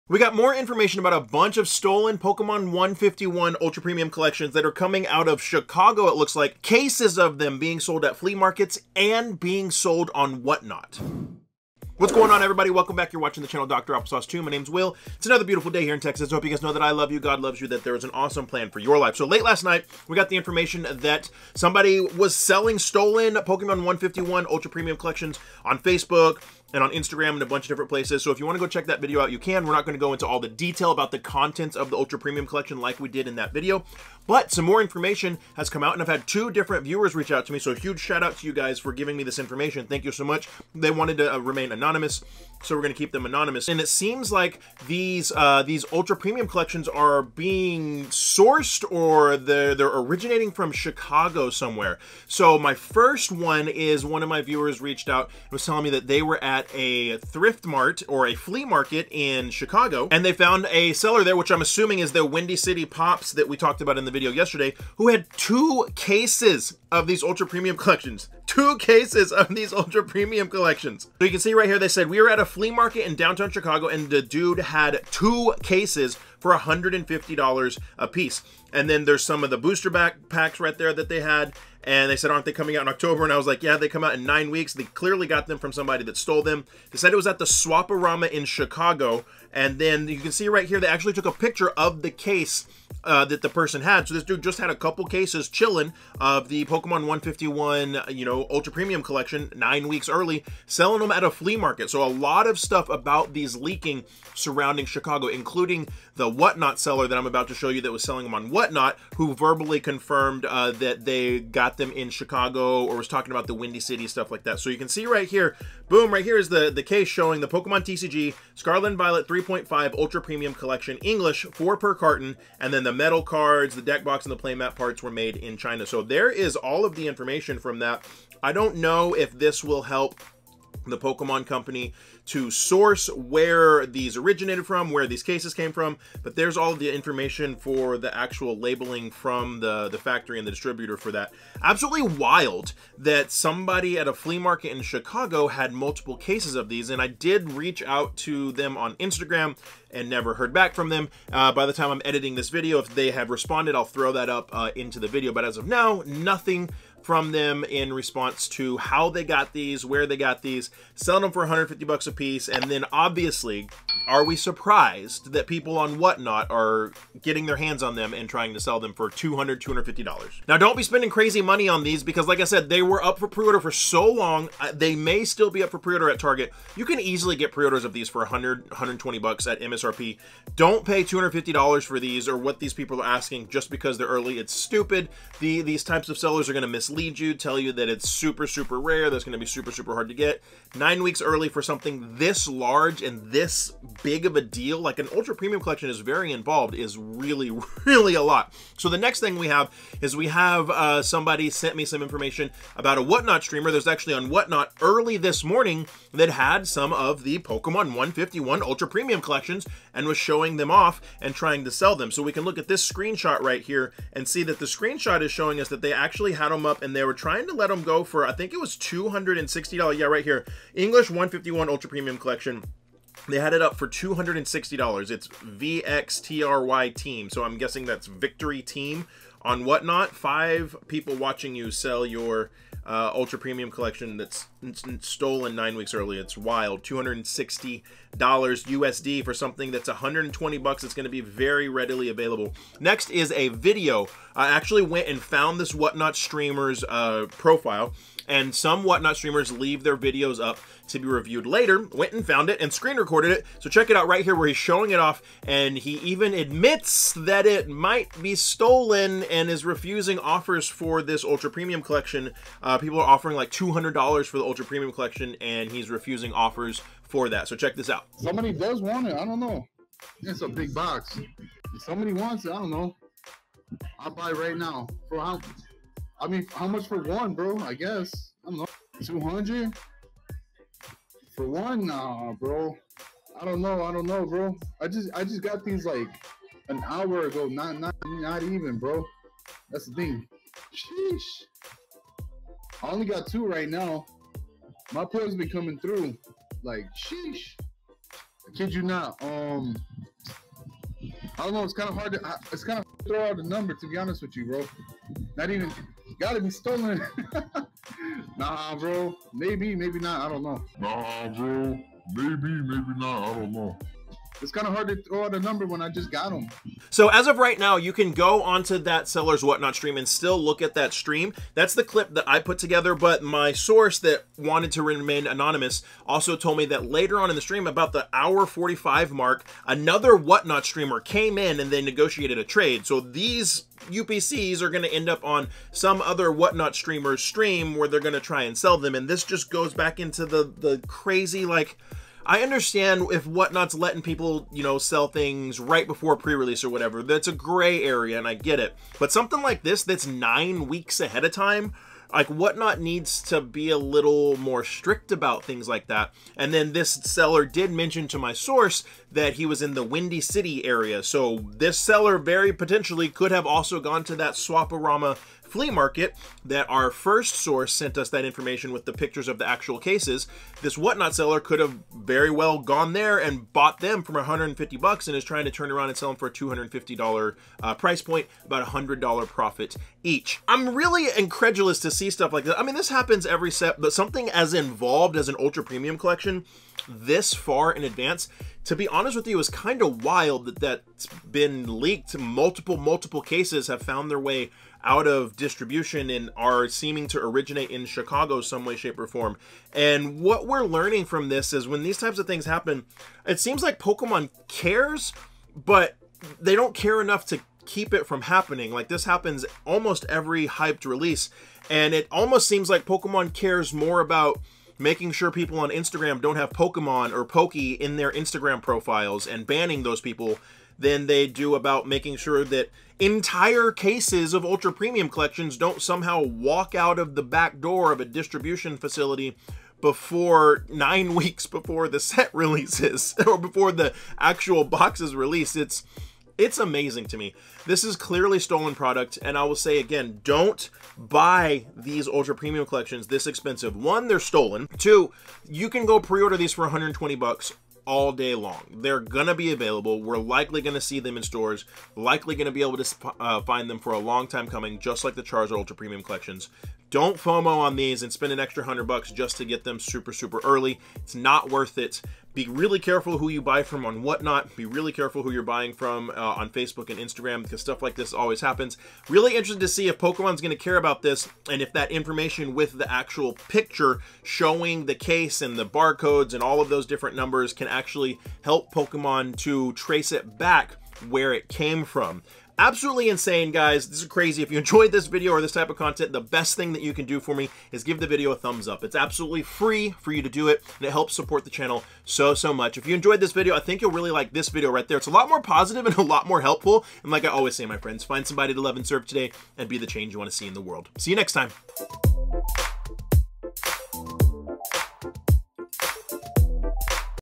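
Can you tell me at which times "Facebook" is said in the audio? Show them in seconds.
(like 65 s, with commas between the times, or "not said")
25 s, 466 s.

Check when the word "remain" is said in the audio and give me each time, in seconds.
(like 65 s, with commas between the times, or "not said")
41 s, 324 s.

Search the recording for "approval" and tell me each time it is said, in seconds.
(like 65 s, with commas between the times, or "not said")
not said.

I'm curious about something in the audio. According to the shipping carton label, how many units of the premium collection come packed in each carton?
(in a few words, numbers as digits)
4.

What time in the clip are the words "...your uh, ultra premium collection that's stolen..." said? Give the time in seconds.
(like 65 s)
232 s.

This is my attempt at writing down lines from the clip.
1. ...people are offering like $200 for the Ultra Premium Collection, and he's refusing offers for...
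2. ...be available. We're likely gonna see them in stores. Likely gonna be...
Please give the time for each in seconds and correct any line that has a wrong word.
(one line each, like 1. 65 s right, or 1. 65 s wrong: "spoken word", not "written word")
1. 262 s right
2. 449 s right.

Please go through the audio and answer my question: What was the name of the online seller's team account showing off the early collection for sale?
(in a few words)
VXTRY team.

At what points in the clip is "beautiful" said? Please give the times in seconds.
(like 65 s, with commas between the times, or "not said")
15 s.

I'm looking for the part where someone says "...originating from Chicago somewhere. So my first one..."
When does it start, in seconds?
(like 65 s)
49 s.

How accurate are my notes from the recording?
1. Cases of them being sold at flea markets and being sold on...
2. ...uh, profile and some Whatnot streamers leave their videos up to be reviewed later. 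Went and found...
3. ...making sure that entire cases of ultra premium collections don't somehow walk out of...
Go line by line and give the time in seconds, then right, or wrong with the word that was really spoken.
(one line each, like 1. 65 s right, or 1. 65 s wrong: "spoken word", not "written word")
1. 6 s right
2. 246 s right
3. 421 s right.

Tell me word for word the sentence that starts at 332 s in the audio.
So these UPCs are going to end up on some other whatnot streamer's stream where they're going to try and sell them.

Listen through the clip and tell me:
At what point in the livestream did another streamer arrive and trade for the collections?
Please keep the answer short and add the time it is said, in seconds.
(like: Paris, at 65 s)
hour 45, at 328 s.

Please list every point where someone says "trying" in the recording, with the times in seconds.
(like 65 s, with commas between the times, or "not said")
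168 s, 211 s, 217 s, 375 s.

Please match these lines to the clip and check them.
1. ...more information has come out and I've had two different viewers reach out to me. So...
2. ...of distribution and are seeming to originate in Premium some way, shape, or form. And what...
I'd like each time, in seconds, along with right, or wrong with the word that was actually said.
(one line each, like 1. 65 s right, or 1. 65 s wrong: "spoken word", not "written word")
1. 34 s right
2. 395 s wrong: "Chicago", not "Premium".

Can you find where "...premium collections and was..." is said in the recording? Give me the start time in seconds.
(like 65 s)
208 s.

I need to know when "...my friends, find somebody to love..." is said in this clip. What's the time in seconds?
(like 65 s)
497 s.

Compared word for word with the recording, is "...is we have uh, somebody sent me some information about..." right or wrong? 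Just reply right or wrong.
right.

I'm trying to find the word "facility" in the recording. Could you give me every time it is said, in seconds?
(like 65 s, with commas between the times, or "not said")
428 s.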